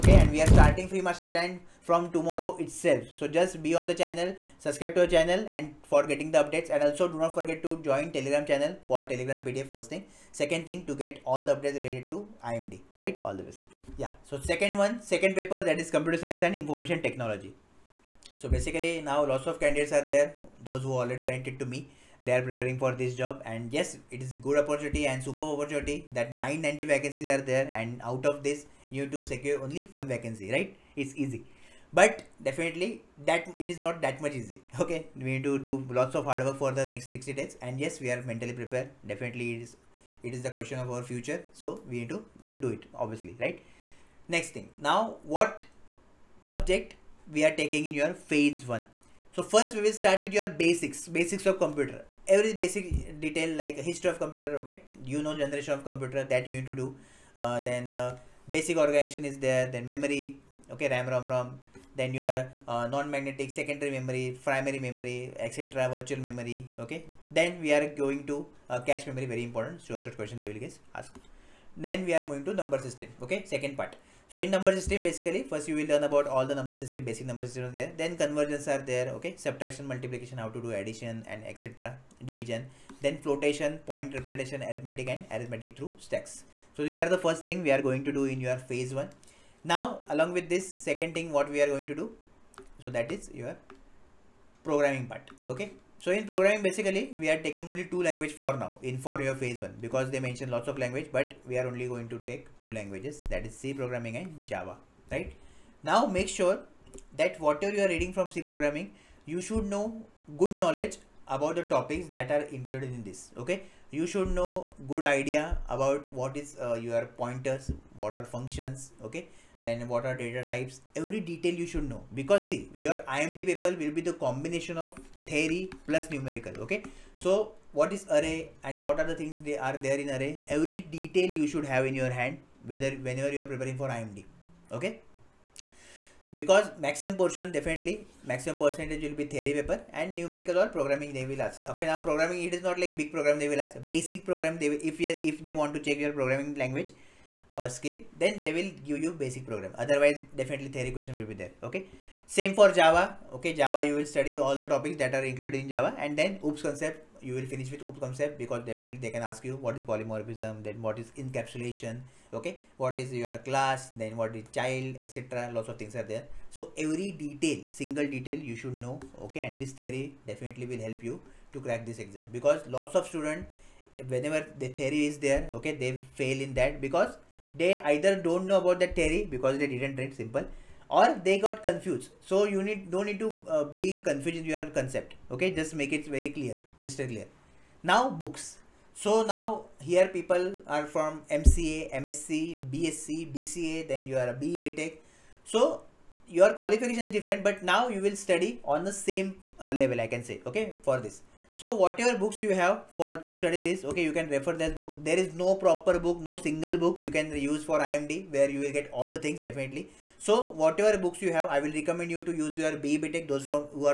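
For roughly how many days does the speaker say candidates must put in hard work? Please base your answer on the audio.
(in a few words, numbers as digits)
60.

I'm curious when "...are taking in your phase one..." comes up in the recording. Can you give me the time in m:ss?
0:47.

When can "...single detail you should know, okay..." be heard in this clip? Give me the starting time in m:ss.
2:47.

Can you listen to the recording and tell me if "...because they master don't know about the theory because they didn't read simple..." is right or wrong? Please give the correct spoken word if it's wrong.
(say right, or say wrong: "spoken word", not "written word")
wrong: "either", not "master".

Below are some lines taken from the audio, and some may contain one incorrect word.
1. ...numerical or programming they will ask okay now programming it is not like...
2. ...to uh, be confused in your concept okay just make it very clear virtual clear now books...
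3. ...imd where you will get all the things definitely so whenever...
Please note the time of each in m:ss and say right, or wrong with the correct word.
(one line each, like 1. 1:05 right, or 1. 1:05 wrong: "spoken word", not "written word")
1. 2:20 right
2. 3:03 wrong: "crystal", not "virtual"
3. 3:27 wrong: "whatever", not "whenever".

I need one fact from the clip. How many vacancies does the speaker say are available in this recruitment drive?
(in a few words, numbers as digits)
990.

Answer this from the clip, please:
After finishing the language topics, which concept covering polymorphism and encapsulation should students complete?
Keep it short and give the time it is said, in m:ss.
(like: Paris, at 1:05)
OOP concept, at 2:36.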